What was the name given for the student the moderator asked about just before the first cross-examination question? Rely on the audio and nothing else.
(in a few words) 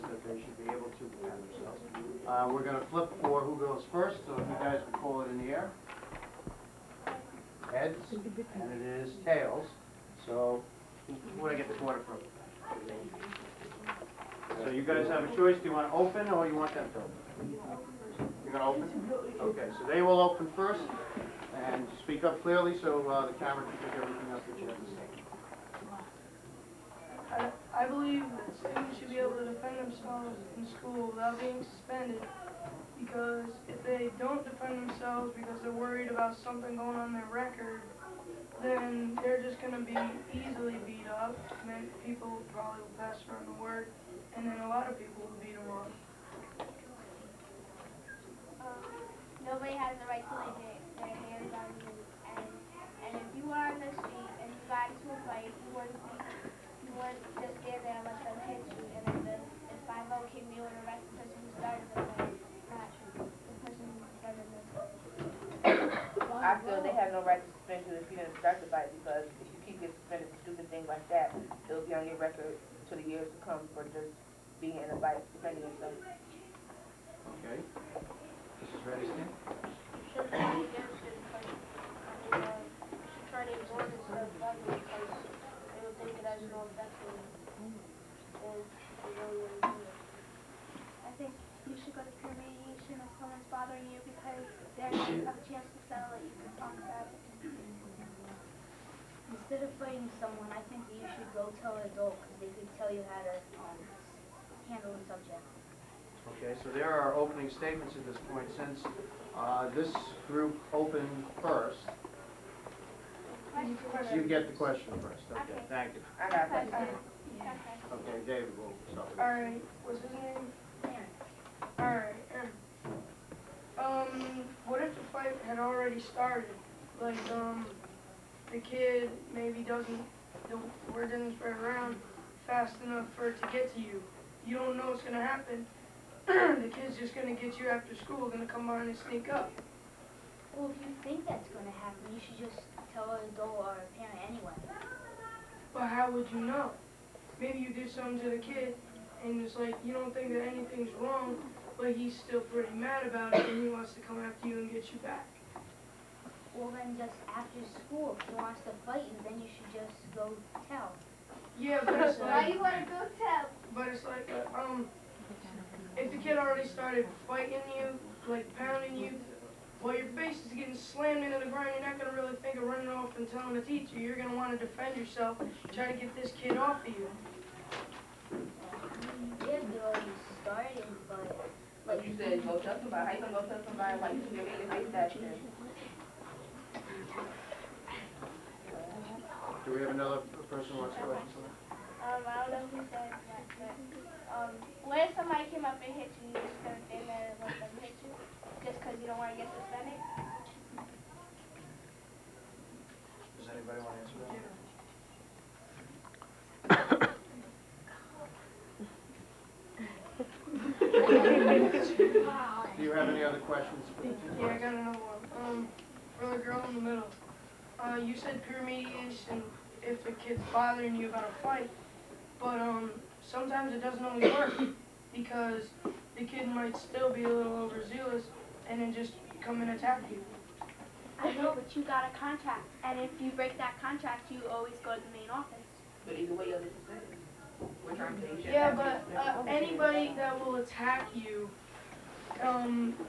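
Aaron.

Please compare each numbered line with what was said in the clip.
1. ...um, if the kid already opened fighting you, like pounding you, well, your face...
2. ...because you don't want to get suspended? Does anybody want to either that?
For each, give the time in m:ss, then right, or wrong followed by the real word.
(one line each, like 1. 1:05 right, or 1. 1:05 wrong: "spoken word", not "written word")
1. 2:44 wrong: "started", not "opened"
2. 3:18 wrong: "answer", not "either".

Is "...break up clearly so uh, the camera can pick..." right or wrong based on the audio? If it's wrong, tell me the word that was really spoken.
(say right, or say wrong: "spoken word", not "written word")
wrong: "speak", not "break".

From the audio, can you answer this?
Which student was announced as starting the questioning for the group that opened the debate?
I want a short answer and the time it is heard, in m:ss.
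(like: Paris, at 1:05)
David, at 1:58.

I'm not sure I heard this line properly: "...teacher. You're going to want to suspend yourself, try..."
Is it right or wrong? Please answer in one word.
wrong.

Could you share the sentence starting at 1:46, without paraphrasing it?
Okay, so there are opening statements at this point.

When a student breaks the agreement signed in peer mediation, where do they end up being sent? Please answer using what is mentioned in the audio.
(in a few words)
the main office.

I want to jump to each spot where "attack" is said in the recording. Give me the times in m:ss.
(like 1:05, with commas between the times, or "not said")
3:49, 4:00.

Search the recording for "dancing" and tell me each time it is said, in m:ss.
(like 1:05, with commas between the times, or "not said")
not said.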